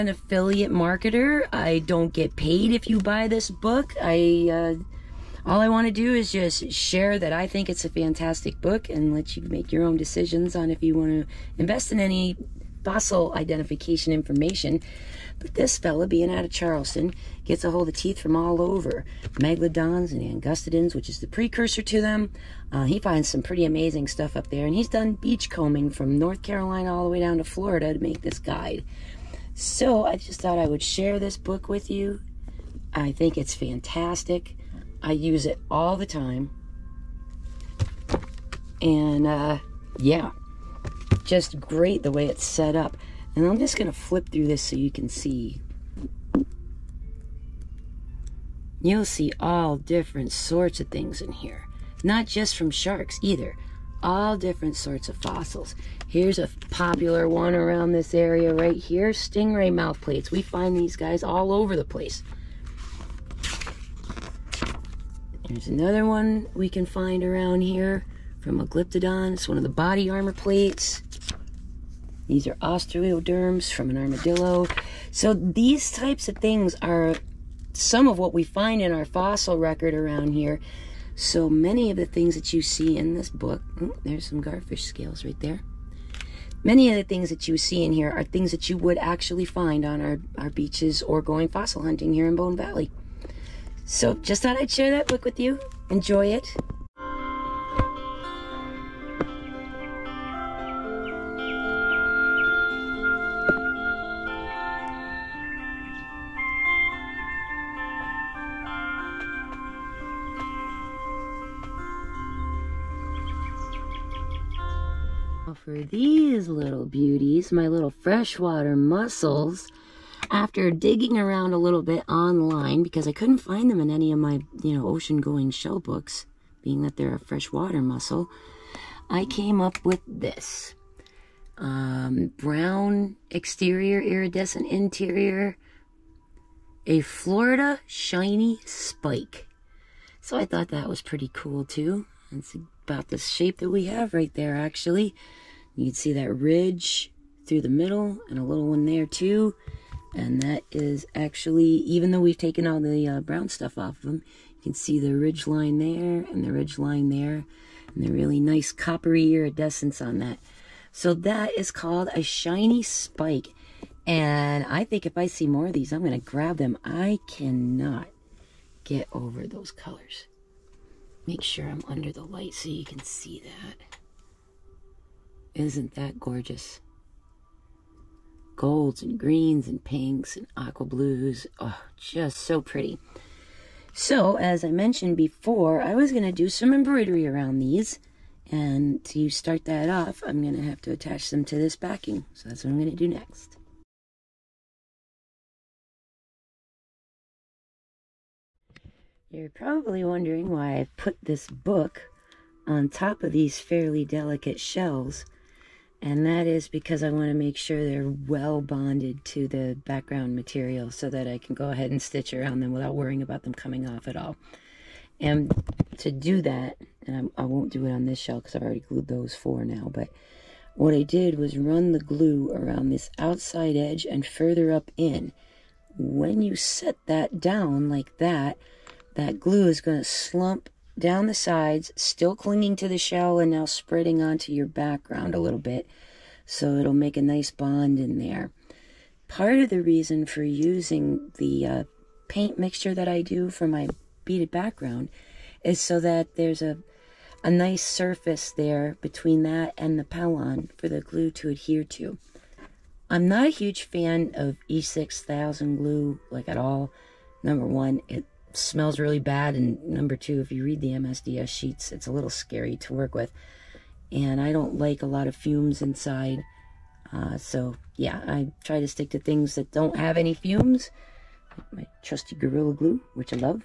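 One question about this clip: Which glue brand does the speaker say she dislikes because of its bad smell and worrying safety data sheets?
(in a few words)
E6000.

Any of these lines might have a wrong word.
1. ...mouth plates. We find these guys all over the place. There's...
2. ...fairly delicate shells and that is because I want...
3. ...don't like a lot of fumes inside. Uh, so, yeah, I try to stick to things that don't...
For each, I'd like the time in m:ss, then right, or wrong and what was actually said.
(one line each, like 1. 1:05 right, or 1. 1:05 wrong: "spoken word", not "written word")
1. 0:59 right
2. 3:23 right
3. 4:24 right.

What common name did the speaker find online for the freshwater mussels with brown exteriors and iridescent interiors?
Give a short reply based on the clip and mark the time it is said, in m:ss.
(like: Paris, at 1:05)
Florida shiny spike, at 2:17.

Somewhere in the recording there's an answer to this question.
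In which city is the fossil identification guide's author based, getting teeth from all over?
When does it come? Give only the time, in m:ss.
0:16.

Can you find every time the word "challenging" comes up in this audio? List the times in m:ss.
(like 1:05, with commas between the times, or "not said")
not said.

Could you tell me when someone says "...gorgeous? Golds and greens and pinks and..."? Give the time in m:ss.
2:56.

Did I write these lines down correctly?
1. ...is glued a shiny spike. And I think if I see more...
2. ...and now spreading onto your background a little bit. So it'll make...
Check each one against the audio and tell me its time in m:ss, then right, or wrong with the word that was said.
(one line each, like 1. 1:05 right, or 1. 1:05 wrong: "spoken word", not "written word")
1. 2:41 wrong: "called", not "glued"
2. 3:53 right.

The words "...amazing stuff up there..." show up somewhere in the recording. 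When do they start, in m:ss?
0:23.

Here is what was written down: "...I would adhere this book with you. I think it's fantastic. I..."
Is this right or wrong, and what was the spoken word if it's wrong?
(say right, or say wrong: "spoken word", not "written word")
wrong: "share", not "adhere".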